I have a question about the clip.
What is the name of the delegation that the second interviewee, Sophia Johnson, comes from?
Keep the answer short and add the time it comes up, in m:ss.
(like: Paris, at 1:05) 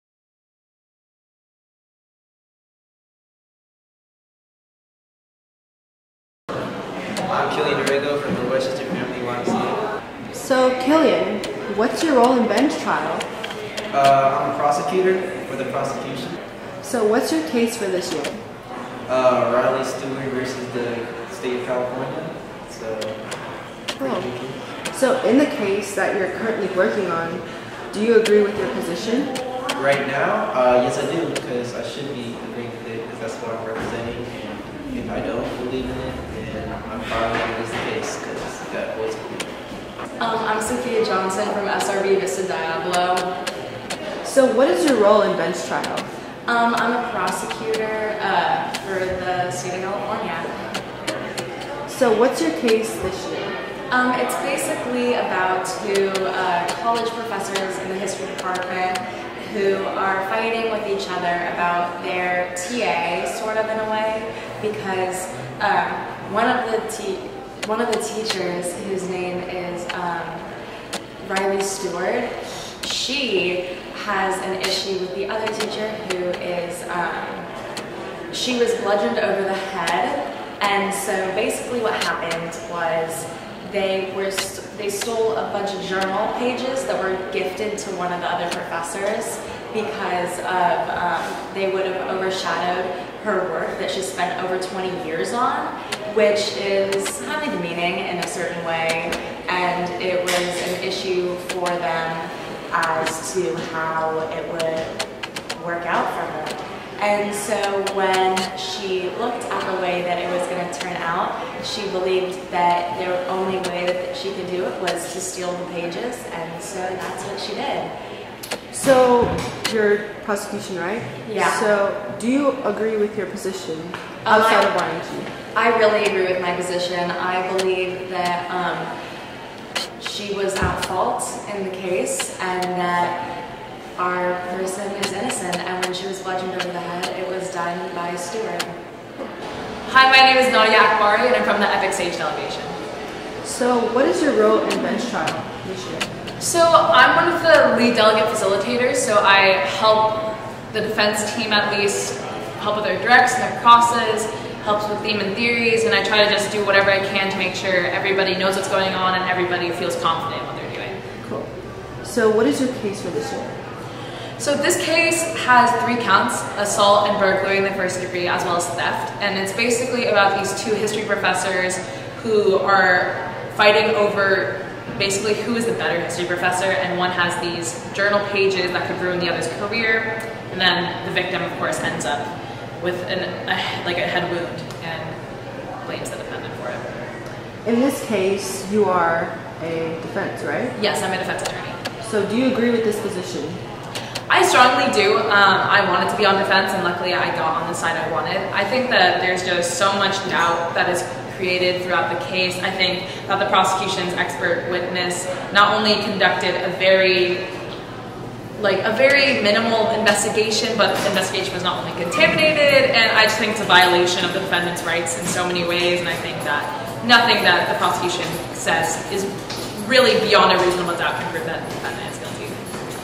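SRB Vista Diablo, at 0:41.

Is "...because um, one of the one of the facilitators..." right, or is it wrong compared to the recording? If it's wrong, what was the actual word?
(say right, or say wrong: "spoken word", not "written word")
wrong: "teachers", not "facilitators".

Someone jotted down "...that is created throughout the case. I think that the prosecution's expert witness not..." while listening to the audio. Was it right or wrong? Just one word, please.
right.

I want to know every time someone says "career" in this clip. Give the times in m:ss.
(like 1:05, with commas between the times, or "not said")
2:59.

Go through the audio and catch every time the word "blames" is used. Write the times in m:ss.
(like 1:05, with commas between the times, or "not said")
3:05.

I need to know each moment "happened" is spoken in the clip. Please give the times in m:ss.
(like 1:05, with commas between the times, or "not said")
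1:22.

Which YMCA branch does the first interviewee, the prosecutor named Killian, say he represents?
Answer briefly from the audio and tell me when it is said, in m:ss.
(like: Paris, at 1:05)
Westchester Family YMCA, at 0:08.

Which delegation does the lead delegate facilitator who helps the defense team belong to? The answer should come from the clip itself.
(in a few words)
Epic Sage Delegation.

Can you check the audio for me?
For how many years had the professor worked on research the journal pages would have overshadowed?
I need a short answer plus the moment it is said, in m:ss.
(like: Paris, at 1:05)
20, at 1:34.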